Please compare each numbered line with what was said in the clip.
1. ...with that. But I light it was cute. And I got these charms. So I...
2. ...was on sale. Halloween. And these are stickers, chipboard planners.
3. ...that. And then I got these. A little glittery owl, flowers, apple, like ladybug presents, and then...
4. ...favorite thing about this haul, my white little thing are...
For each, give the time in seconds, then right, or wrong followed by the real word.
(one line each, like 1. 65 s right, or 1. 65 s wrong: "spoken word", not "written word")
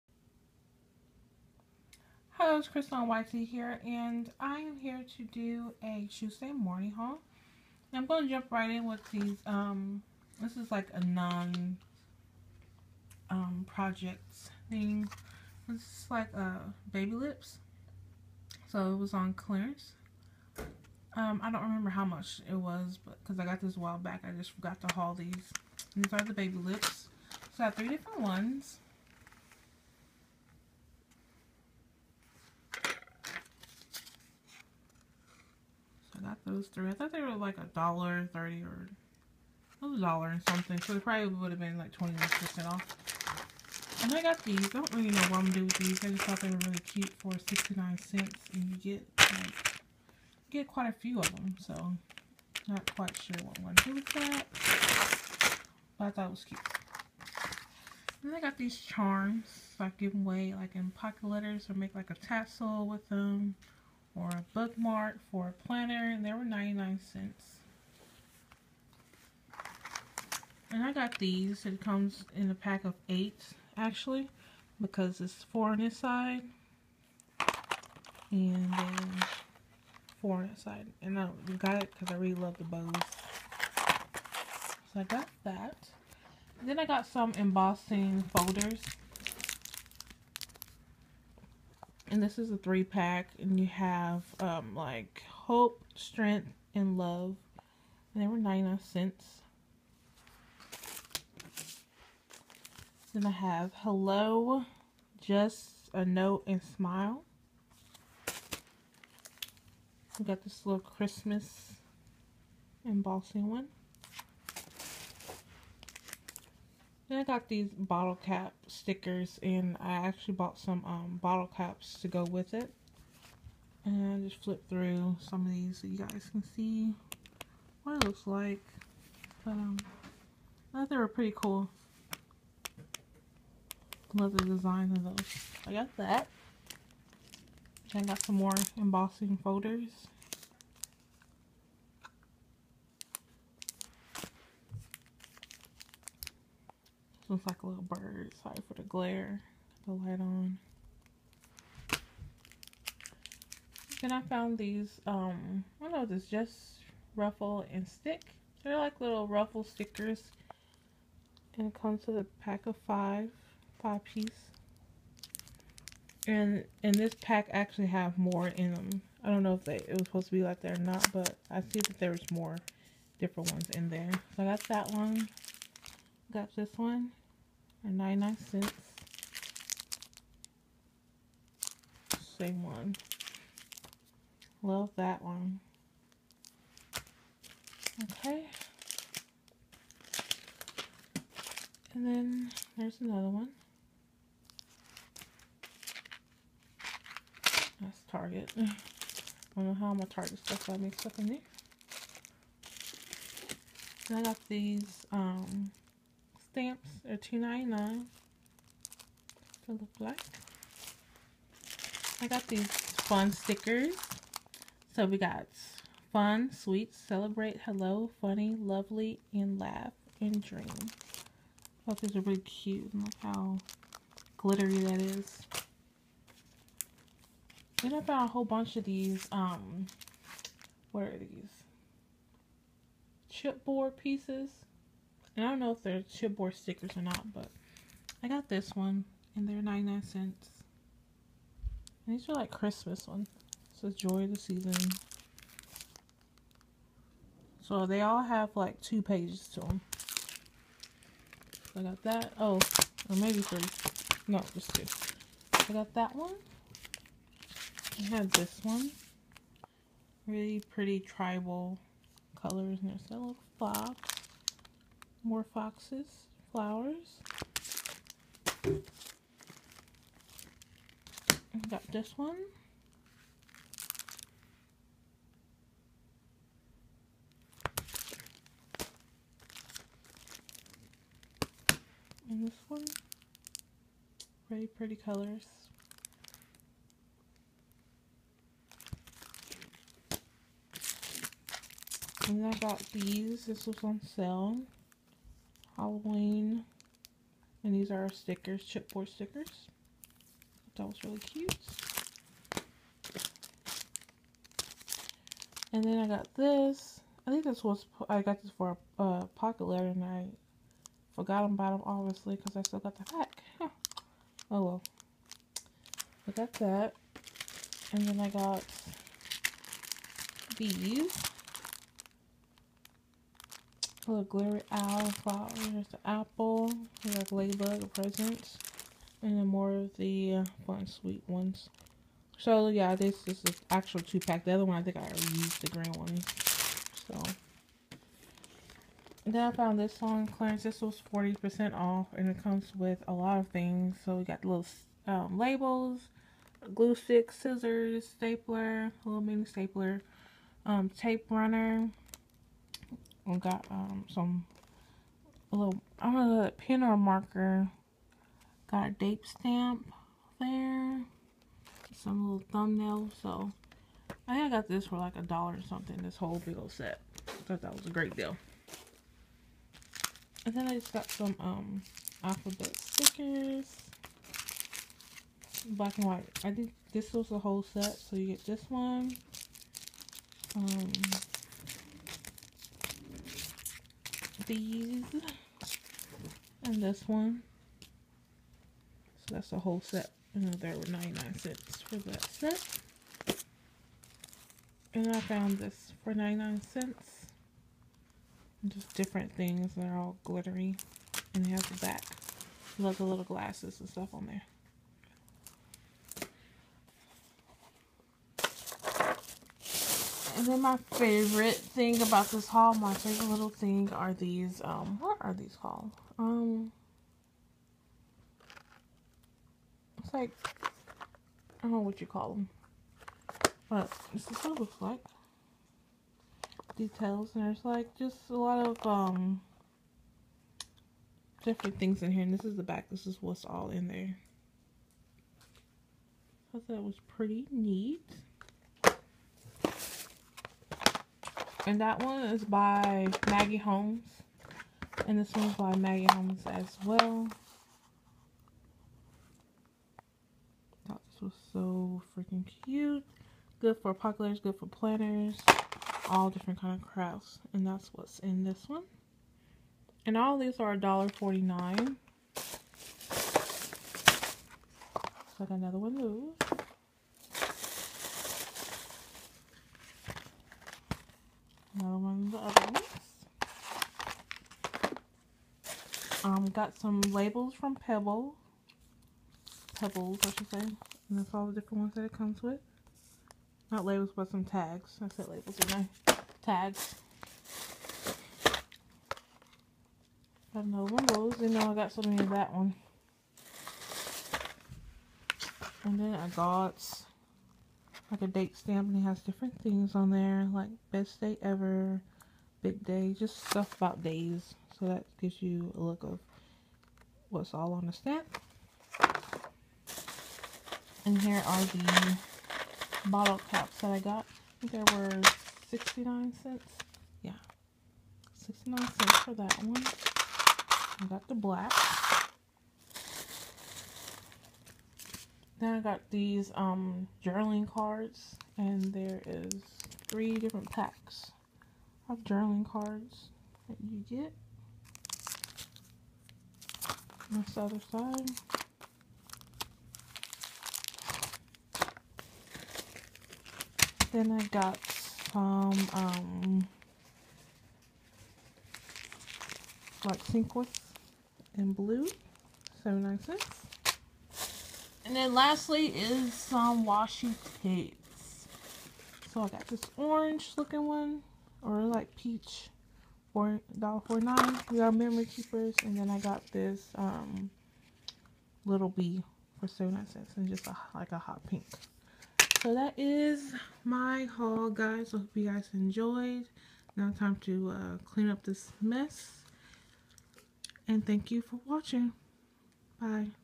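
1. 53 s wrong: "thought", not "light"
2. 293 s wrong: "stickers", not "planners"
3. 316 s right
4. 410 s wrong: "favorite", not "white".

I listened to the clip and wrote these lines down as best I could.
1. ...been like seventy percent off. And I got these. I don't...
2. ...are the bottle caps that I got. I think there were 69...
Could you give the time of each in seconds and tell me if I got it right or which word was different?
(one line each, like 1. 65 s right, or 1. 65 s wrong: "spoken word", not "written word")
1. 41 s wrong: "twenty", not "seventy"
2. 511 s right.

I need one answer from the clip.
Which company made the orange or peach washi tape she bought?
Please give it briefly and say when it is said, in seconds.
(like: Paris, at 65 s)
We R Memory Keepers, at 564 s.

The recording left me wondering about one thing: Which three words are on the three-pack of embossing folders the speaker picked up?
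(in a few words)
hope, strength and love.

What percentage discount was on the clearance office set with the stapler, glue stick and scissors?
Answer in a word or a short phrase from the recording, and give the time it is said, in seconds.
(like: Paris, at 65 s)
40%, at 341 s.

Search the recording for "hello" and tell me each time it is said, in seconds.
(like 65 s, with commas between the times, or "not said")
2 s, 103 s, 217 s.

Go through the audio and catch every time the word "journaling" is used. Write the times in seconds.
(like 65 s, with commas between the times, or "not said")
527 s, 532 s.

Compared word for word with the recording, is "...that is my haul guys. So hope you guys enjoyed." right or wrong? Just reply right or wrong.
right.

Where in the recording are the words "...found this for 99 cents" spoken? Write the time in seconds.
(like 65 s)
395 s.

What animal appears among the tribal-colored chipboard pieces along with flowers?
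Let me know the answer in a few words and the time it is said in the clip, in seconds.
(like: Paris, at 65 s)
fox, at 263 s.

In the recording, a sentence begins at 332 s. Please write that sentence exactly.
So yeah, this, this is actual two pack.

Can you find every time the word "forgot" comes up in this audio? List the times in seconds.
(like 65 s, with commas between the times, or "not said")
24 s, 311 s.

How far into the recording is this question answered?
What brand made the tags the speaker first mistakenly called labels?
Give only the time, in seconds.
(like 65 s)
479 s.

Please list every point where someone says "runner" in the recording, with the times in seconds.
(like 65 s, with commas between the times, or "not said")
351 s.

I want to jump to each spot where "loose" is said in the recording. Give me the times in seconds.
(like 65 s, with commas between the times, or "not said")
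465 s.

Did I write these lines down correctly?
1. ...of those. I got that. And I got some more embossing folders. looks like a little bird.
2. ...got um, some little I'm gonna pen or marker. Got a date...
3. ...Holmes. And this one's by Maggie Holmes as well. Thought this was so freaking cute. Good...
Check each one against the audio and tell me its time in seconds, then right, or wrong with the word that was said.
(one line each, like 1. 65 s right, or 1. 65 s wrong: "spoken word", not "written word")
1. 134 s right
2. 353 s right
3. 443 s right.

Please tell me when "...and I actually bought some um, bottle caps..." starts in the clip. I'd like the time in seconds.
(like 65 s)
119 s.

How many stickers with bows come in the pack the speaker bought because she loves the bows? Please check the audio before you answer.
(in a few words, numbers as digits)
8.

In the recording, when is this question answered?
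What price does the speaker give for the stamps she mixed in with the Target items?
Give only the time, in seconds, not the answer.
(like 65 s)
207 s.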